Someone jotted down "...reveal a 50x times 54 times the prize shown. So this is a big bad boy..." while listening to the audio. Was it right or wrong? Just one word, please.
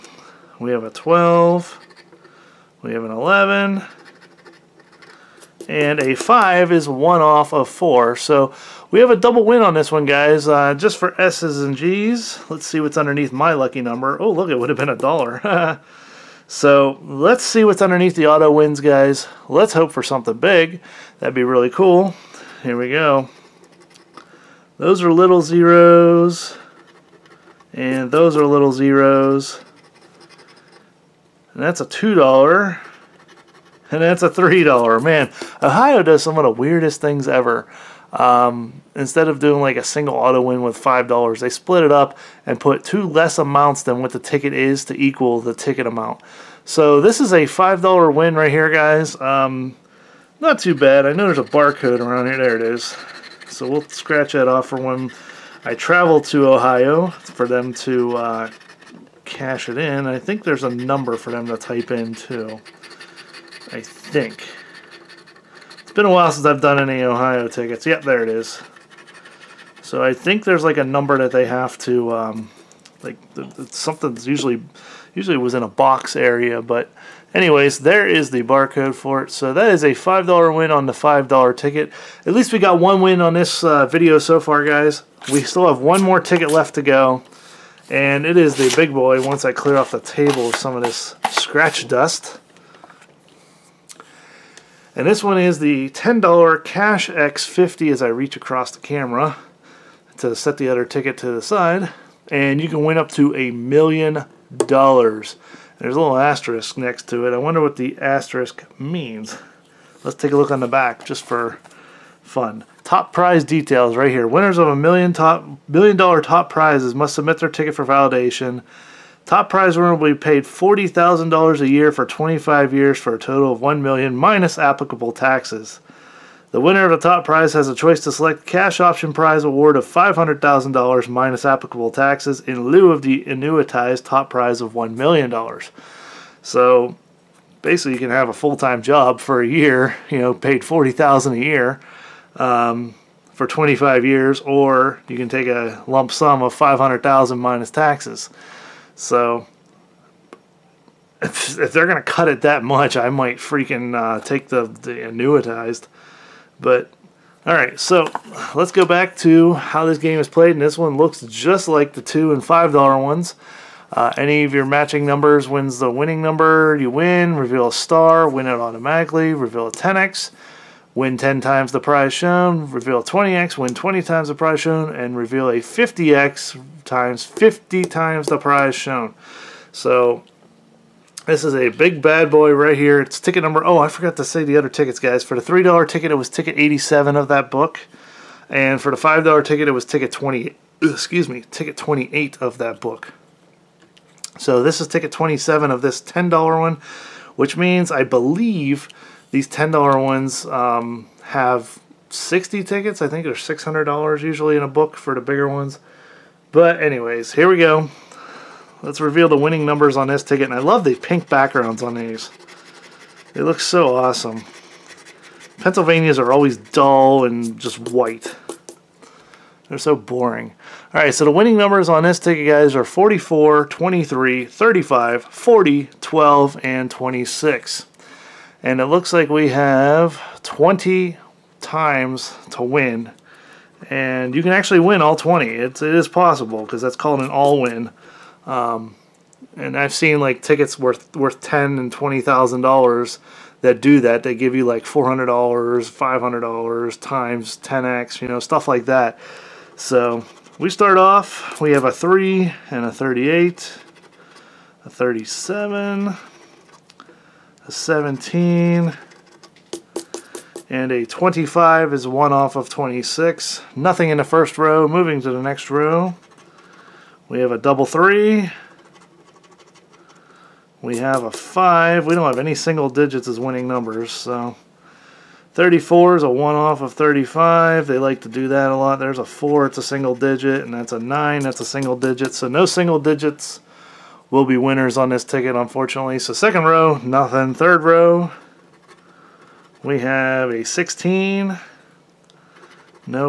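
wrong.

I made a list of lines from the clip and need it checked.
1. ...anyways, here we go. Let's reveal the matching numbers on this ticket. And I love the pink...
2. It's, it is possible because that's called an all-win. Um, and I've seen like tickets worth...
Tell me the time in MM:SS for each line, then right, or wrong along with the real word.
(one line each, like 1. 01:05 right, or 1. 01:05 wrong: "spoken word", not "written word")
1. 03:26 wrong: "winning", not "matching"
2. 03:55 right.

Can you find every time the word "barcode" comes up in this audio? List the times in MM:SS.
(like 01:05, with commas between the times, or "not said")
00:51, 01:18.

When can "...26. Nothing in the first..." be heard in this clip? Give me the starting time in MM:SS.
04:22.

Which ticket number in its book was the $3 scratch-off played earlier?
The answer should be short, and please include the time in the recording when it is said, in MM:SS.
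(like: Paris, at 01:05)
87, at 03:06.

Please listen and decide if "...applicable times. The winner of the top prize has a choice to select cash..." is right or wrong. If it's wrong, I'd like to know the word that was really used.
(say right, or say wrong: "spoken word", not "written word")
wrong: "taxes", not "times".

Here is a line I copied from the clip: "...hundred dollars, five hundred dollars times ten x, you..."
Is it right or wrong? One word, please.
right.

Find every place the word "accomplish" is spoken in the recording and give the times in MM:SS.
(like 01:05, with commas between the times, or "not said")
not said.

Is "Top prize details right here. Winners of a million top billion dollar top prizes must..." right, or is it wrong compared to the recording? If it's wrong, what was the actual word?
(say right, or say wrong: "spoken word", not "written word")
right.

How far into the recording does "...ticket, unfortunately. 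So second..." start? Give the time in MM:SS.
04:45.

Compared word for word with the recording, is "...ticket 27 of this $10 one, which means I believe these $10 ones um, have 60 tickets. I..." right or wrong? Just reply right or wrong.
right.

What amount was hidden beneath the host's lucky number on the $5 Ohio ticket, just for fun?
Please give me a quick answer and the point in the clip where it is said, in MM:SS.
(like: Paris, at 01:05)
$1, at 00:14.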